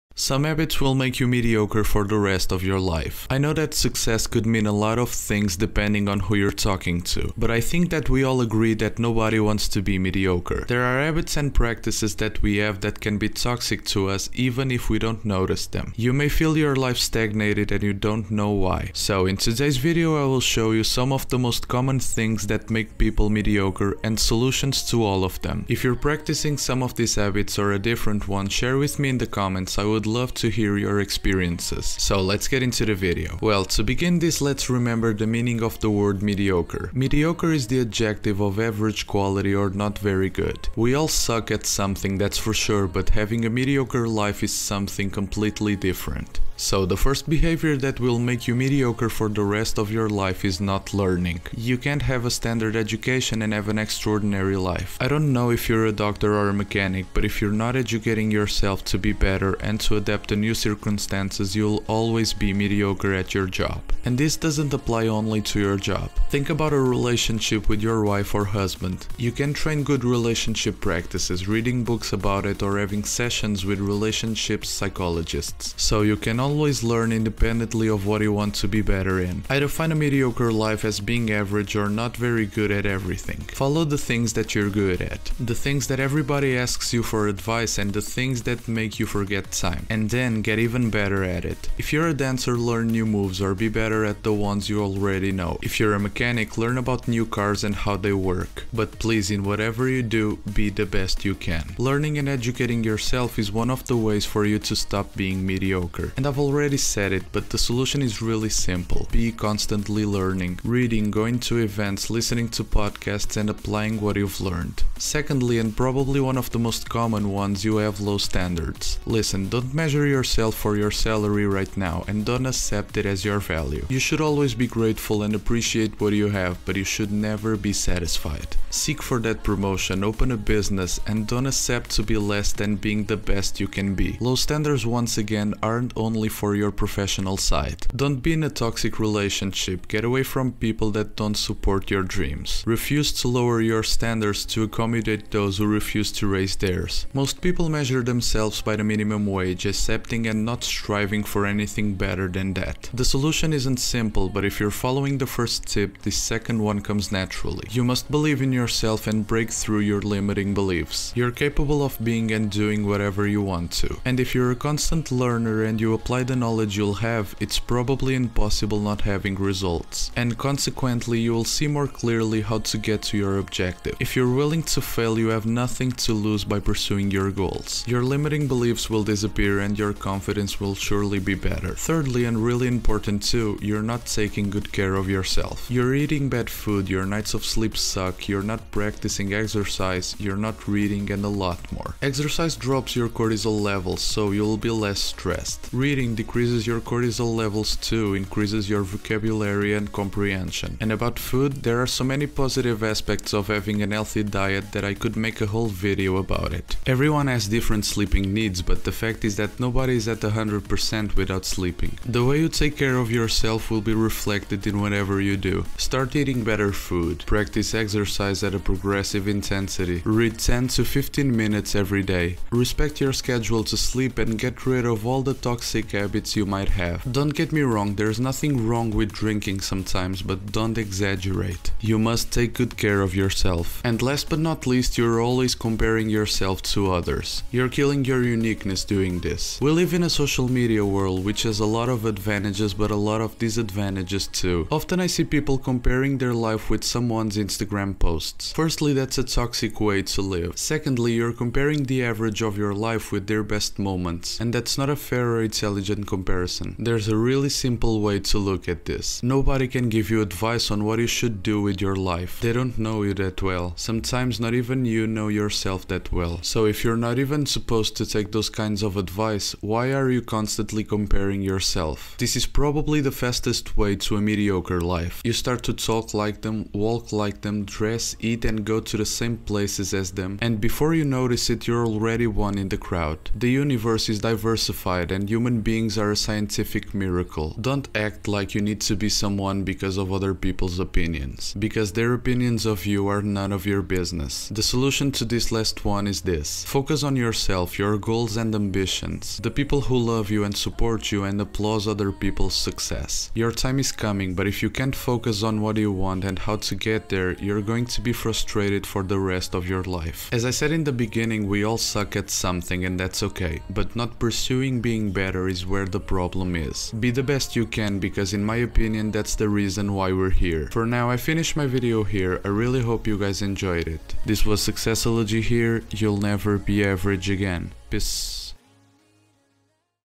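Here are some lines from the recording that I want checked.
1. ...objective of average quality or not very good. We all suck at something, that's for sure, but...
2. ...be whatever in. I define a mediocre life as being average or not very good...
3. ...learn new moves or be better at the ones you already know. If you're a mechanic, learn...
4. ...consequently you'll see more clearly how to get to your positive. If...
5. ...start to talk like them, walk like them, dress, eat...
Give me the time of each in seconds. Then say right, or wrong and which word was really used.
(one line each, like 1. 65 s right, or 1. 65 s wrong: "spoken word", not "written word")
1. 37 s wrong: "adjective", not "objective"
2. 78 s wrong: "better", not "whatever"
3. 92 s right
4. 170 s wrong: "objective", not "positive"
5. 275 s right.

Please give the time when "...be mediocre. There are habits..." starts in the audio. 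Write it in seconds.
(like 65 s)
9 s.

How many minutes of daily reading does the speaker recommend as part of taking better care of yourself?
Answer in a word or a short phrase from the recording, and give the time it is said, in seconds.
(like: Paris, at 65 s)
10 to 15, at 220 s.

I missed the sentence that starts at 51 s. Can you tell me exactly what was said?
You can't have a standard education and have an extraordinary life.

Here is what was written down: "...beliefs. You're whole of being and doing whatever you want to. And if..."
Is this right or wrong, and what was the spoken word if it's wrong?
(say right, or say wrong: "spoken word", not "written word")
wrong: "capable", not "whole".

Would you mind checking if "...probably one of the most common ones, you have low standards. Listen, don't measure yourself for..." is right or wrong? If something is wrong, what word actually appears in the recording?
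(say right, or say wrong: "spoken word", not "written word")
right.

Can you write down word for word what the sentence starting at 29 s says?
I would love to hear your experiences.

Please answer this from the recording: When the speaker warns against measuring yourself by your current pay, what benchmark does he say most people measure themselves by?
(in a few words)
minimum wage.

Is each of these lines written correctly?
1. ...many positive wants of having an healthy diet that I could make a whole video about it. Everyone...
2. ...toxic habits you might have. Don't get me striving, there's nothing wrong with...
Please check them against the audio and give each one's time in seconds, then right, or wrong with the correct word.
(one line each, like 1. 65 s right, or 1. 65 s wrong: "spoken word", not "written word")
1. 202 s wrong: "aspects", not "wants"
2. 225 s wrong: "wrong", not "striving".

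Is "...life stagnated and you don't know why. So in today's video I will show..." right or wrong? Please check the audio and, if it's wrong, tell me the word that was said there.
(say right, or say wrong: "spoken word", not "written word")
right.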